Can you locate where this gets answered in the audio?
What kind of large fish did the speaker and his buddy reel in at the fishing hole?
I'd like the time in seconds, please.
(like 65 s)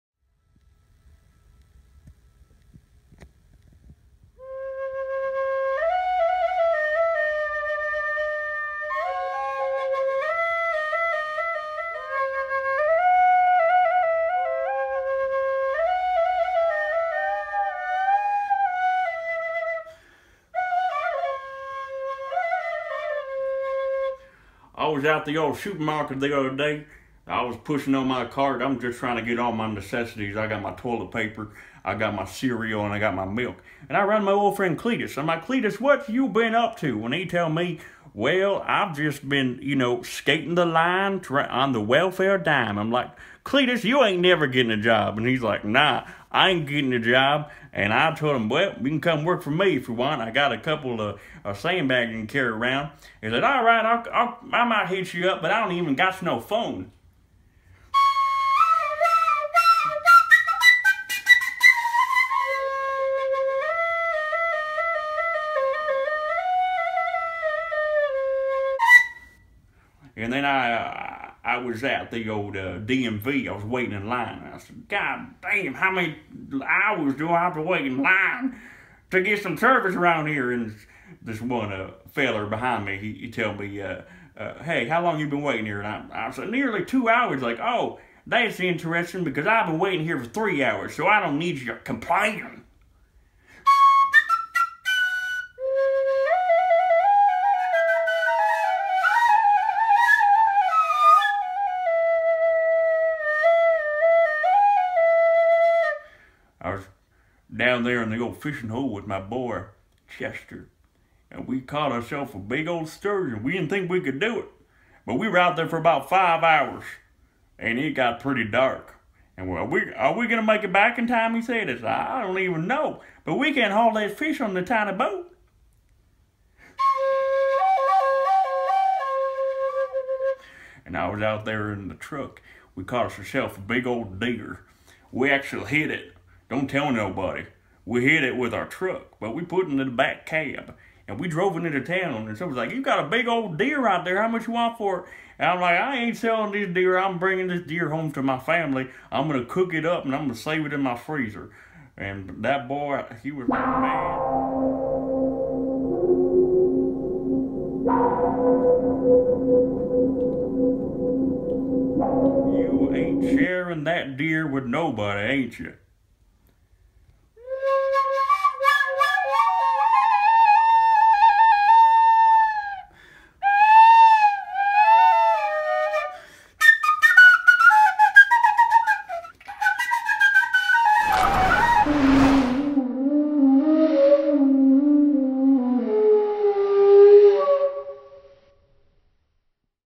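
112 s.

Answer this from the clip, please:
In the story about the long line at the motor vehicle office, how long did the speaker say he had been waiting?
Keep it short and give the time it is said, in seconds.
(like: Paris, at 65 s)
nearly 2 hours, at 86 s.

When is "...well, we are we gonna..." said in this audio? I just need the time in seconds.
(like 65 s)
119 s.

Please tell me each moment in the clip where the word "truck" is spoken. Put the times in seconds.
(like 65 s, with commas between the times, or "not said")
131 s, 138 s.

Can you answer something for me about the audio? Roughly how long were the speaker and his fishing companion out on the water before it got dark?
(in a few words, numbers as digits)
about 5 hours.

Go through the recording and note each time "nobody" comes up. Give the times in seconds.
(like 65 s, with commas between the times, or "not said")
136 s, 164 s.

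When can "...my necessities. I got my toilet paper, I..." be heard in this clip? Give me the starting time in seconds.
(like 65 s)
29 s.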